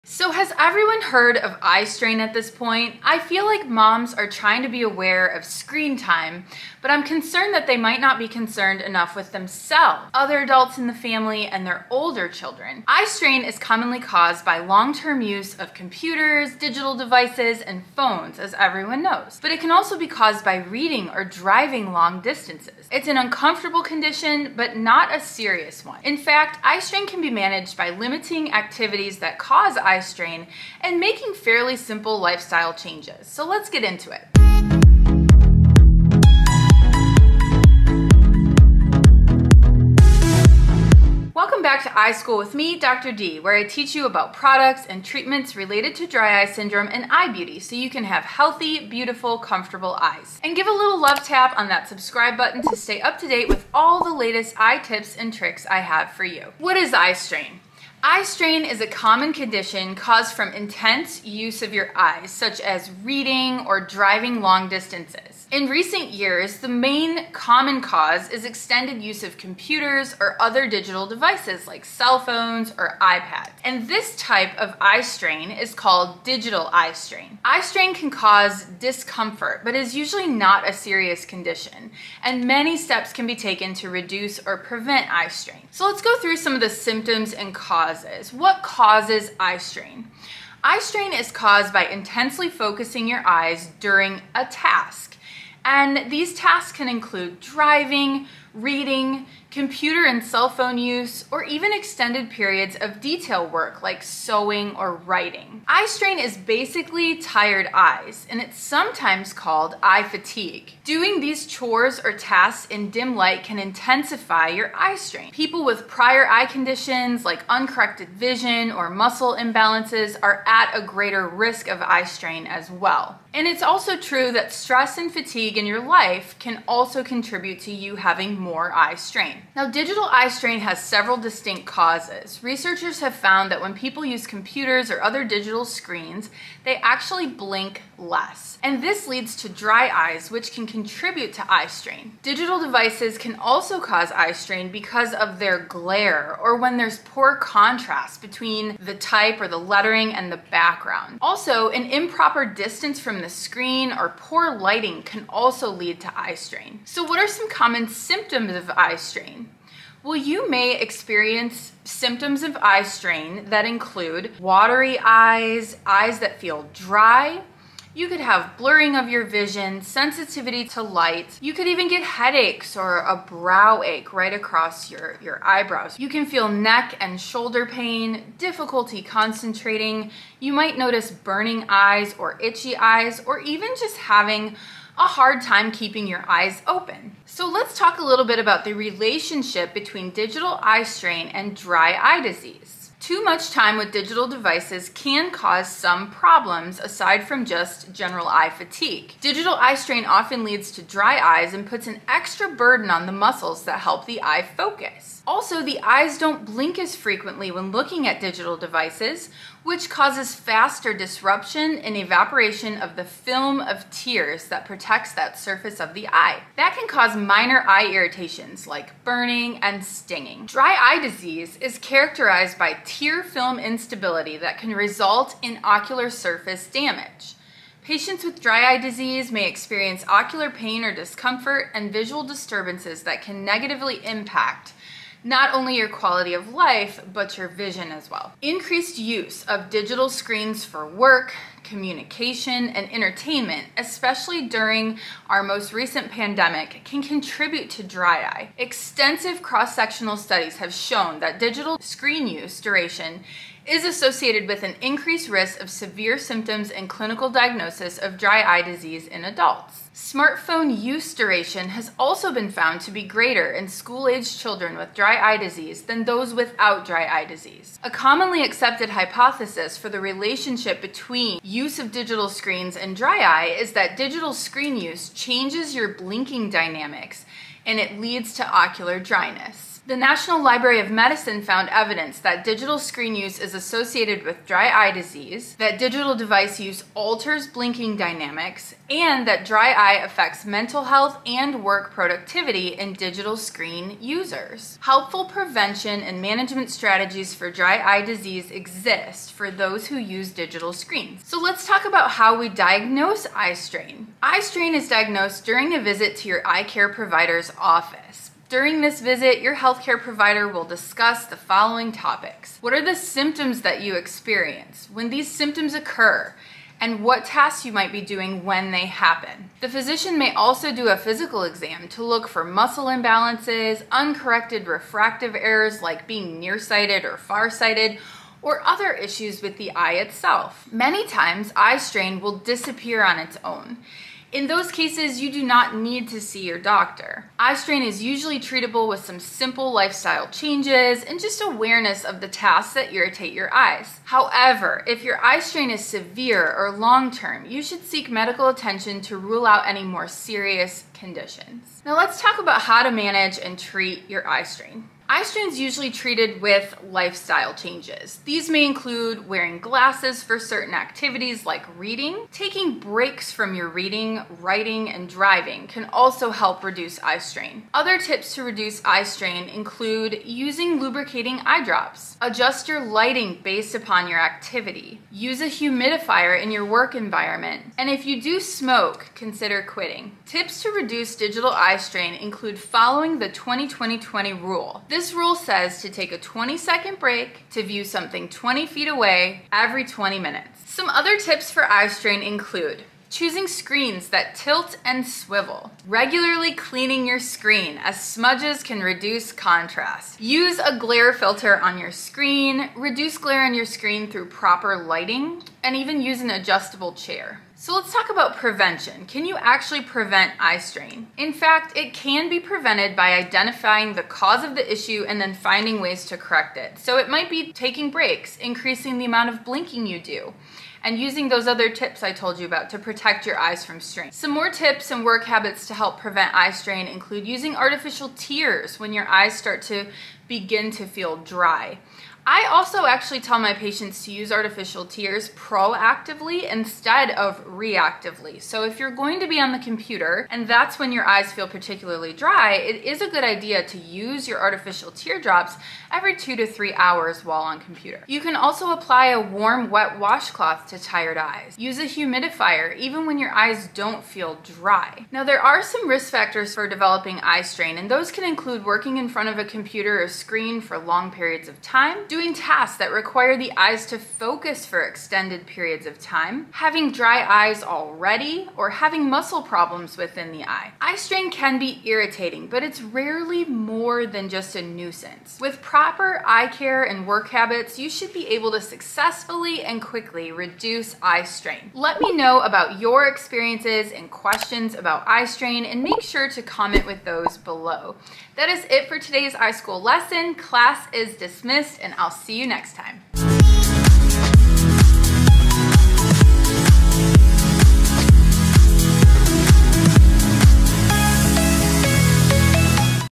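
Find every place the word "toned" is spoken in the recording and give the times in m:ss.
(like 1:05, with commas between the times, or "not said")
not said.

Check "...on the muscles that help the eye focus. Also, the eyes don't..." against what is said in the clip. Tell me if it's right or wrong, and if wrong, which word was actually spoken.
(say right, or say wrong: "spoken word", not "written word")
right.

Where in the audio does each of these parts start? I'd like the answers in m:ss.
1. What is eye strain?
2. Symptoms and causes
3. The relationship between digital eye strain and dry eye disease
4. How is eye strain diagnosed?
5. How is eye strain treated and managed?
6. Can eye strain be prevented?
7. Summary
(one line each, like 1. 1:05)
1. 0:56
2. 1:25
3. 3:07
4. 5:01
5. 5:52
6. 6:47
7. 7:50.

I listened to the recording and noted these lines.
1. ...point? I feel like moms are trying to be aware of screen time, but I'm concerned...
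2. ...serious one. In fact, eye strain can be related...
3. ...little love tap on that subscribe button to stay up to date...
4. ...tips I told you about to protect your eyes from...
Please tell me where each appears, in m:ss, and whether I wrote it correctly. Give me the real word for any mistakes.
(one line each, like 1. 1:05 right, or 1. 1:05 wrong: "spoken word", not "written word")
1. 0:02 right
2. 0:25 wrong: "managed", not "related"
3. 0:50 right
4. 7:01 right.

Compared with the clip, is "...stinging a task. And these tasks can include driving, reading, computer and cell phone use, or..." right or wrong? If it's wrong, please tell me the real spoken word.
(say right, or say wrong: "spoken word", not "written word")
wrong: "during", not "stinging".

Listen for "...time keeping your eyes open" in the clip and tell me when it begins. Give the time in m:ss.
3:05.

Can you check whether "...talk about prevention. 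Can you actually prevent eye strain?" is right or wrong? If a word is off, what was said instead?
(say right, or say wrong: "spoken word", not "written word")
right.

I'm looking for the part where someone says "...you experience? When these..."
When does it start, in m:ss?
5:13.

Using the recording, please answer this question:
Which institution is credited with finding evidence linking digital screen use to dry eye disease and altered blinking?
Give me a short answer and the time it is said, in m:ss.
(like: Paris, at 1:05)
National Library of Medicine, at 4:39.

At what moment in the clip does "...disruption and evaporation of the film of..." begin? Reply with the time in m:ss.
3:30.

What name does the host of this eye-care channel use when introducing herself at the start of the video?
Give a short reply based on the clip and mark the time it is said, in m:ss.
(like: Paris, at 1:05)
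Dr. D, at 0:42.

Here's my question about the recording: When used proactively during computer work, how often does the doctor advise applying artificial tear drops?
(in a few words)
every 2 to 3 hours.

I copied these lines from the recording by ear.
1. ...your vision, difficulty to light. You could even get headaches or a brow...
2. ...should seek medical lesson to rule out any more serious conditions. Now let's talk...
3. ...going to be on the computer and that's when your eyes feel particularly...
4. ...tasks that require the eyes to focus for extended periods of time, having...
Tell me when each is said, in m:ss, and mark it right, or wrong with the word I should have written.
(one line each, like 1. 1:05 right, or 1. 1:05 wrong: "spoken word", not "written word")
1. 2:49 wrong: "sensitivity", not "difficulty"
2. 5:47 wrong: "attention", not "lesson"
3. 7:18 right
4. 7:42 right.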